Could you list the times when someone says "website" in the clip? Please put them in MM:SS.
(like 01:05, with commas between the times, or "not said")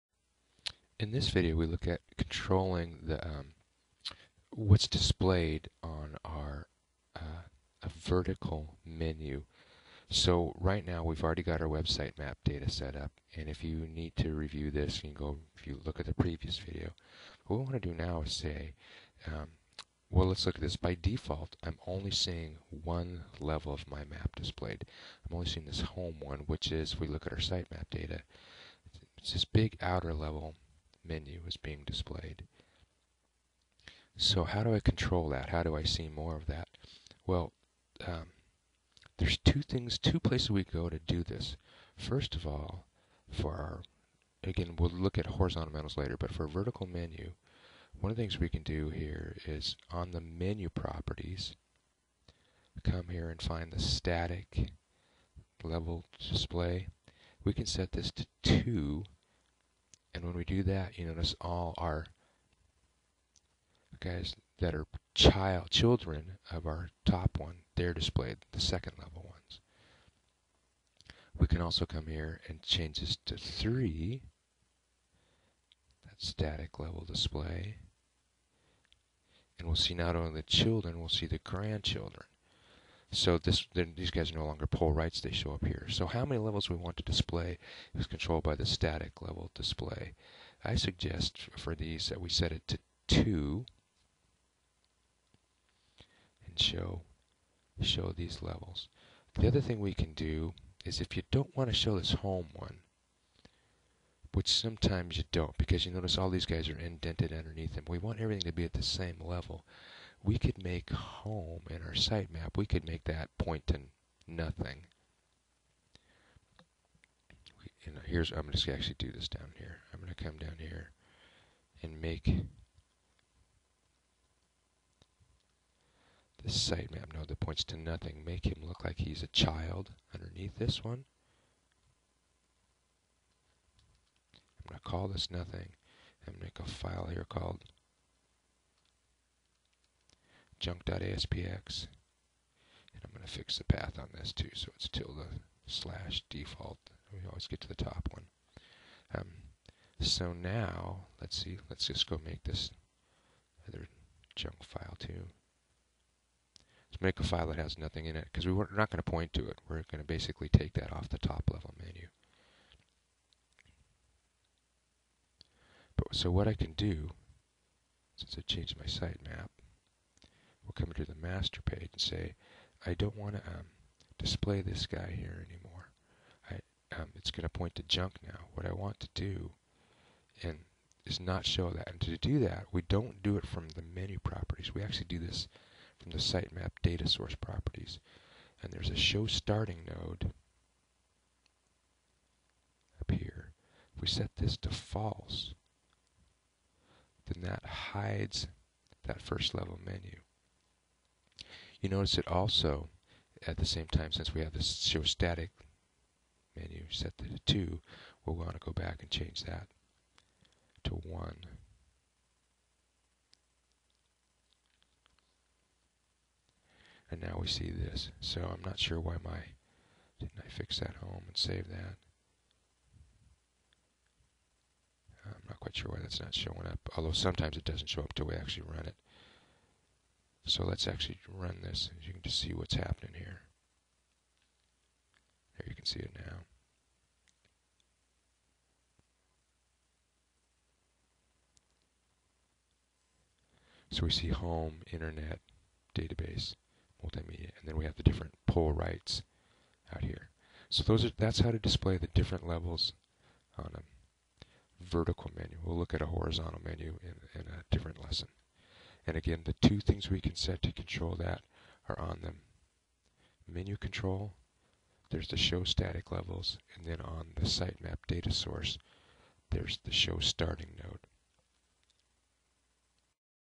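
00:11.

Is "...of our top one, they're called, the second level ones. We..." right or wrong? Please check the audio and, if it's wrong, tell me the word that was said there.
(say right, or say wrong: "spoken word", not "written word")
wrong: "displayed", not "called".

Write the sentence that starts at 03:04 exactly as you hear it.
We actually do this from the sitemap data source properties.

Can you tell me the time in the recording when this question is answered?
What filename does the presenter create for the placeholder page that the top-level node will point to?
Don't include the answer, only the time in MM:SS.
02:20.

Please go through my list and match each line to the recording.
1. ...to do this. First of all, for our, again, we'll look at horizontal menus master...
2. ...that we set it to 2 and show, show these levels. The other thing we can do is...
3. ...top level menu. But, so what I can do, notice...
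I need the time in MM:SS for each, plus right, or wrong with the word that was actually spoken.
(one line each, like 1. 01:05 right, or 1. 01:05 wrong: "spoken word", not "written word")
1. 00:40 wrong: "later", not "master"
2. 01:32 right
3. 02:41 wrong: "since", not "notice".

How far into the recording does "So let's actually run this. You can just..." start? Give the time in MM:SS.
03:50.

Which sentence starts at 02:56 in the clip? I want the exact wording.
I, um, it's going to point to junk now.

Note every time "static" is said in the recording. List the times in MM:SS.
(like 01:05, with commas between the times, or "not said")
00:53, 01:16, 01:28, 03:25, 04:25.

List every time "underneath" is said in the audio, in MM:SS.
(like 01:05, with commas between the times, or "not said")
01:47, 02:10.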